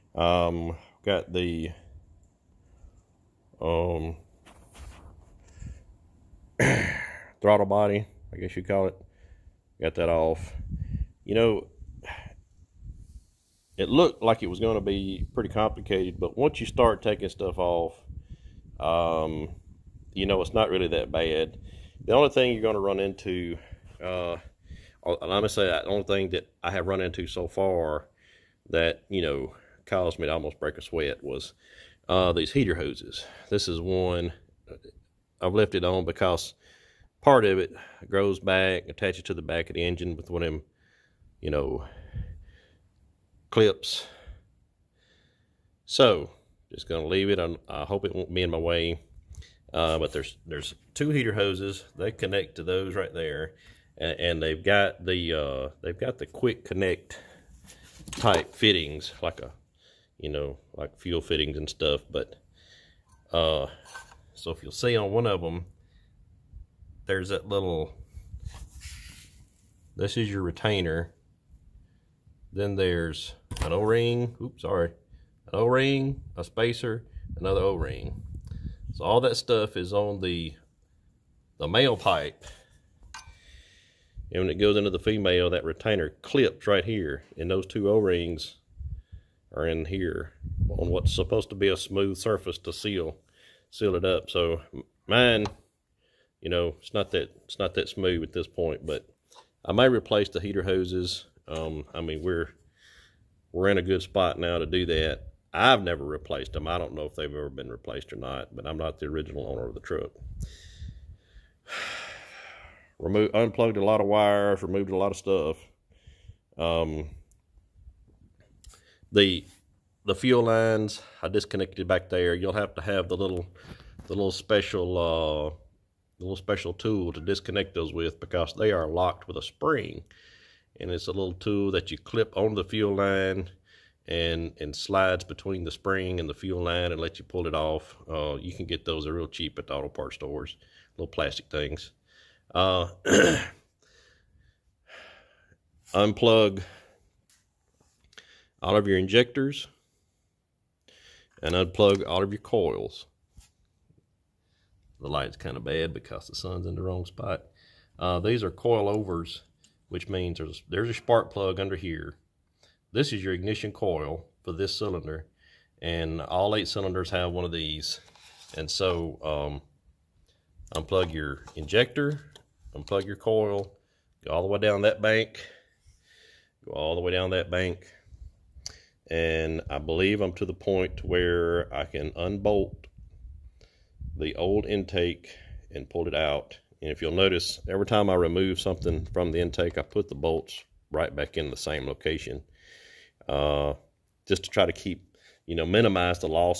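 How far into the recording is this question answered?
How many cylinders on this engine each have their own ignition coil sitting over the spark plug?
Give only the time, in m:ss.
2:46.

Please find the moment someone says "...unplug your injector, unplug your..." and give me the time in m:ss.
2:50.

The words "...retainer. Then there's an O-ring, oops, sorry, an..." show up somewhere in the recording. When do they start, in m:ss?
1:10.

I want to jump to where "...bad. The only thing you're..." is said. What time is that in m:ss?
0:21.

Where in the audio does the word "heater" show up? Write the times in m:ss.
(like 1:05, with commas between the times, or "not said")
0:32, 0:51, 1:40.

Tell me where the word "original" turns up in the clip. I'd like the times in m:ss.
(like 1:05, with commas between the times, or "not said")
1:49.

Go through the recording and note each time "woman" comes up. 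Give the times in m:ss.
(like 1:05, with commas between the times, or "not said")
not said.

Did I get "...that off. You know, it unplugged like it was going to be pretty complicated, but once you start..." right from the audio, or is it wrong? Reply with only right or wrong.
wrong.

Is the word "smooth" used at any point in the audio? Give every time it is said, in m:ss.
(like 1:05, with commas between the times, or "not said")
1:31, 1:37.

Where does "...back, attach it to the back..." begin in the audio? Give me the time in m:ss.
0:38.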